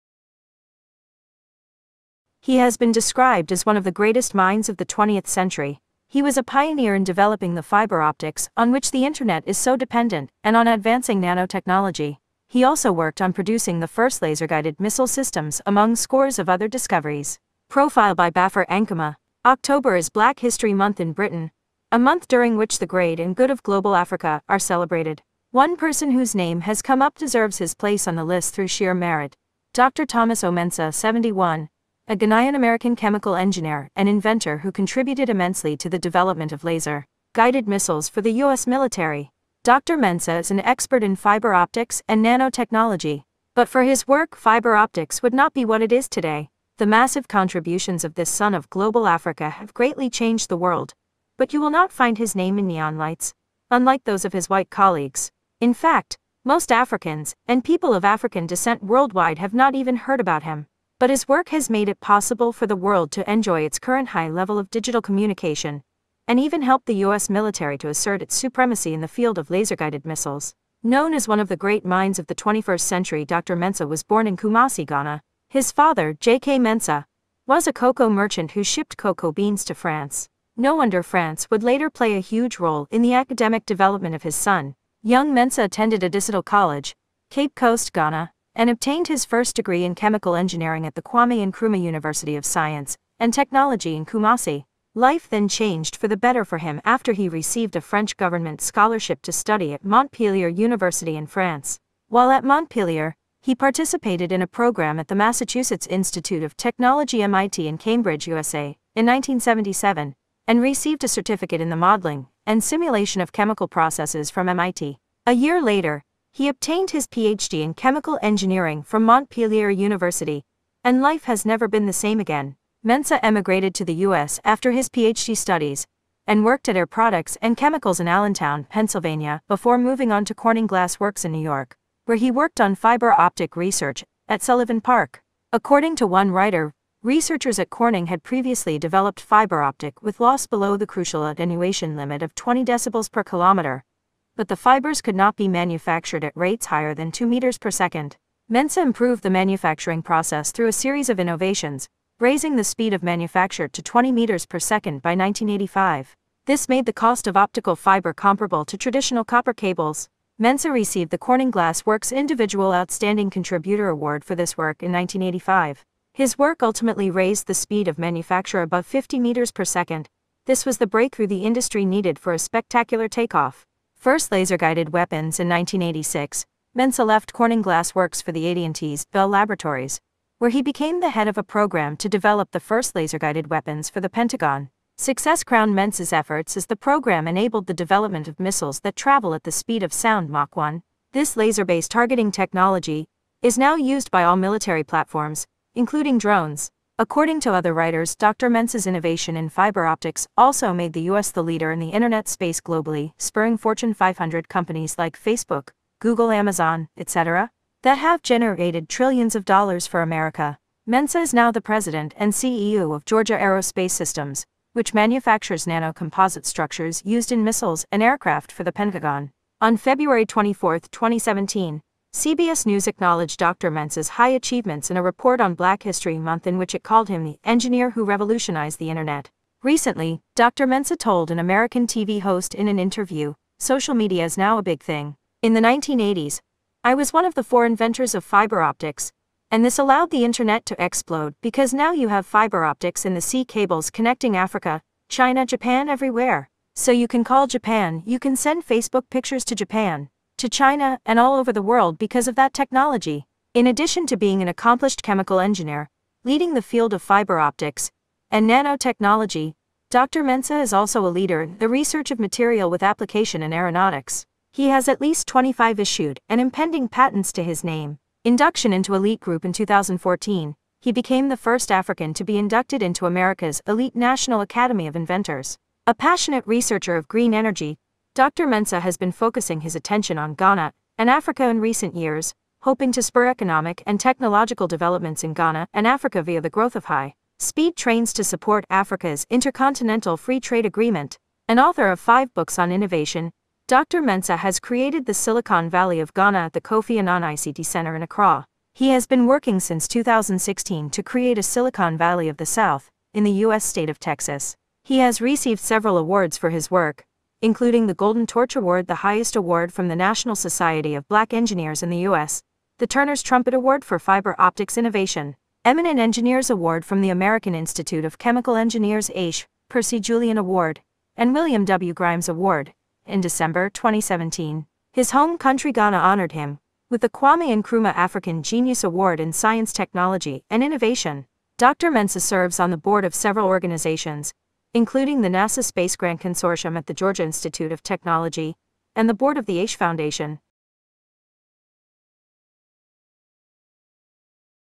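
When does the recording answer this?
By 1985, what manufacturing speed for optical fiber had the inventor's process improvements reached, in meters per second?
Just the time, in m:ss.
2:33.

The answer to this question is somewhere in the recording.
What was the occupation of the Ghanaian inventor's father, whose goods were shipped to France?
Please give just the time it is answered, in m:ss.
1:17.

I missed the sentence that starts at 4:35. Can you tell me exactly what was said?
A passionate researcher of green energy, Dr.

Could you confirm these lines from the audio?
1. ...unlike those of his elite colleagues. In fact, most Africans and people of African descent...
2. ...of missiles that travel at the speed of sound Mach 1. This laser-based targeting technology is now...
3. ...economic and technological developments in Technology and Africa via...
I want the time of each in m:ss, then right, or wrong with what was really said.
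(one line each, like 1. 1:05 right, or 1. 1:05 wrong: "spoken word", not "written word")
1. 0:53 wrong: "white", not "elite"
2. 3:08 right
3. 4:43 wrong: "Ghana", not "Technology".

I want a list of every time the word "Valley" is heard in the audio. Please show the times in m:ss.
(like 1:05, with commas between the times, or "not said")
4:55, 5:01.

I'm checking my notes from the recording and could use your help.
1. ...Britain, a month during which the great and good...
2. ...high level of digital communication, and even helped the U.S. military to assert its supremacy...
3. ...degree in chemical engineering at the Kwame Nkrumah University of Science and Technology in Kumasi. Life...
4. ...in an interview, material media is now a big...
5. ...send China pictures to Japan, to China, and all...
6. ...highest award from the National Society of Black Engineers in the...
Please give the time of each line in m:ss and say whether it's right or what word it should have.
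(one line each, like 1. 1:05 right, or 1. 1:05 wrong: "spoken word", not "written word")
1. 0:21 right
2. 1:04 right
3. 1:29 right
4. 3:52 wrong: "social", not "material"
5. 4:08 wrong: "Facebook", not "China"
6. 5:09 right.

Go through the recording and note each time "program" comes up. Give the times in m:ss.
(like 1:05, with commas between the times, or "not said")
1:44, 3:01, 3:06.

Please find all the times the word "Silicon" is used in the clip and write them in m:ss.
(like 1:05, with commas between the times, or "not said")
4:55, 5:01.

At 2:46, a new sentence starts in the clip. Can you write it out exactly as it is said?
His work ultimately raised the speed of manufacture above 50 meters per second.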